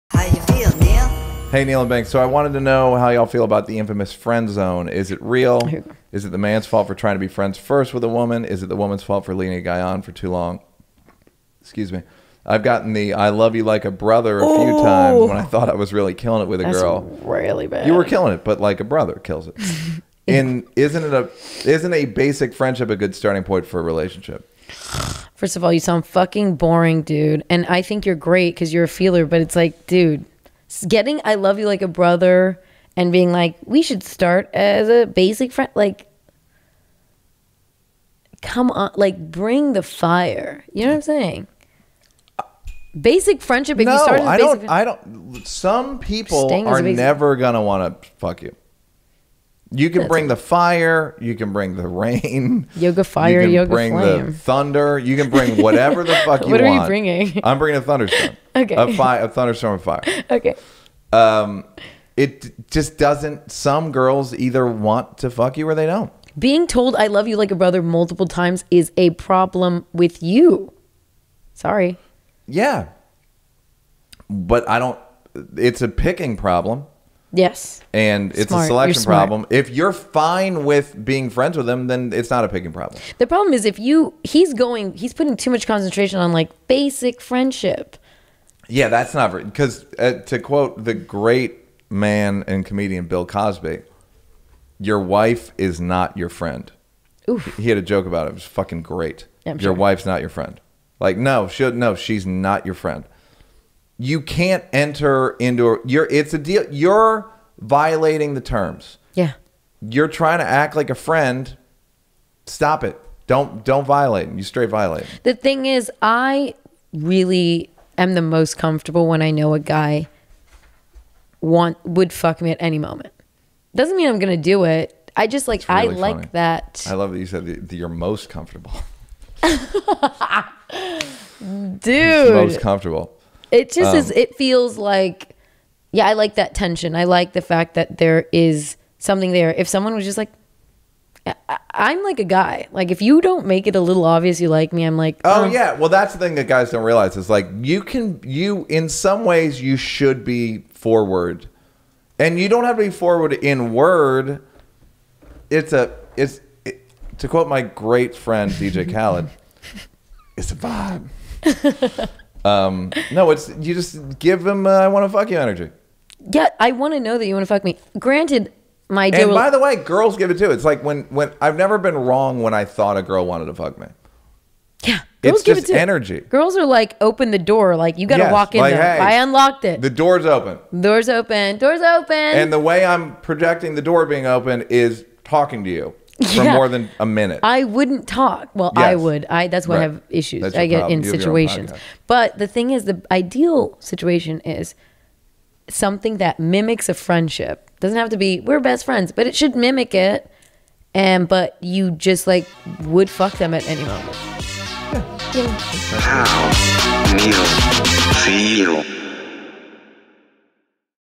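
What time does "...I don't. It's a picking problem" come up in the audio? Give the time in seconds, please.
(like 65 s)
74 s.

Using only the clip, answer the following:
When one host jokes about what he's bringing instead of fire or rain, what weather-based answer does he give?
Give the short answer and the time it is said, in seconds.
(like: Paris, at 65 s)
A thunderstorm of fire, at 59 s.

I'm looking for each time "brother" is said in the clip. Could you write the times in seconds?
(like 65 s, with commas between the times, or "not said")
13 s, 18 s, 31 s, 67 s.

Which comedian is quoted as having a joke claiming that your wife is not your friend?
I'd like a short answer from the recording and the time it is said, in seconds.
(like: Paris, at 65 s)
Bill Cosby, at 93 s.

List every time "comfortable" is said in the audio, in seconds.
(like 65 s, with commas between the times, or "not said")
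118 s, 128 s, 132 s.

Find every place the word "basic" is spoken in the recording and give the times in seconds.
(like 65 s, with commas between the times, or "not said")
22 s, 35 s, 42 s, 86 s.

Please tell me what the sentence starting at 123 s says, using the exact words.
Doesn't mean I'm going to do it.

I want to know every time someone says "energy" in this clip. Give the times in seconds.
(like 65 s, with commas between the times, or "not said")
165 s, 175 s.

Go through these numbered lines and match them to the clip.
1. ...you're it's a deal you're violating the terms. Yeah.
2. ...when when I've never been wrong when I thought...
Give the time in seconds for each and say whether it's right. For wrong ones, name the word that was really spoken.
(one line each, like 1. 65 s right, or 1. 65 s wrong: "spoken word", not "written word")
1. 105 s right
2. 170 s right.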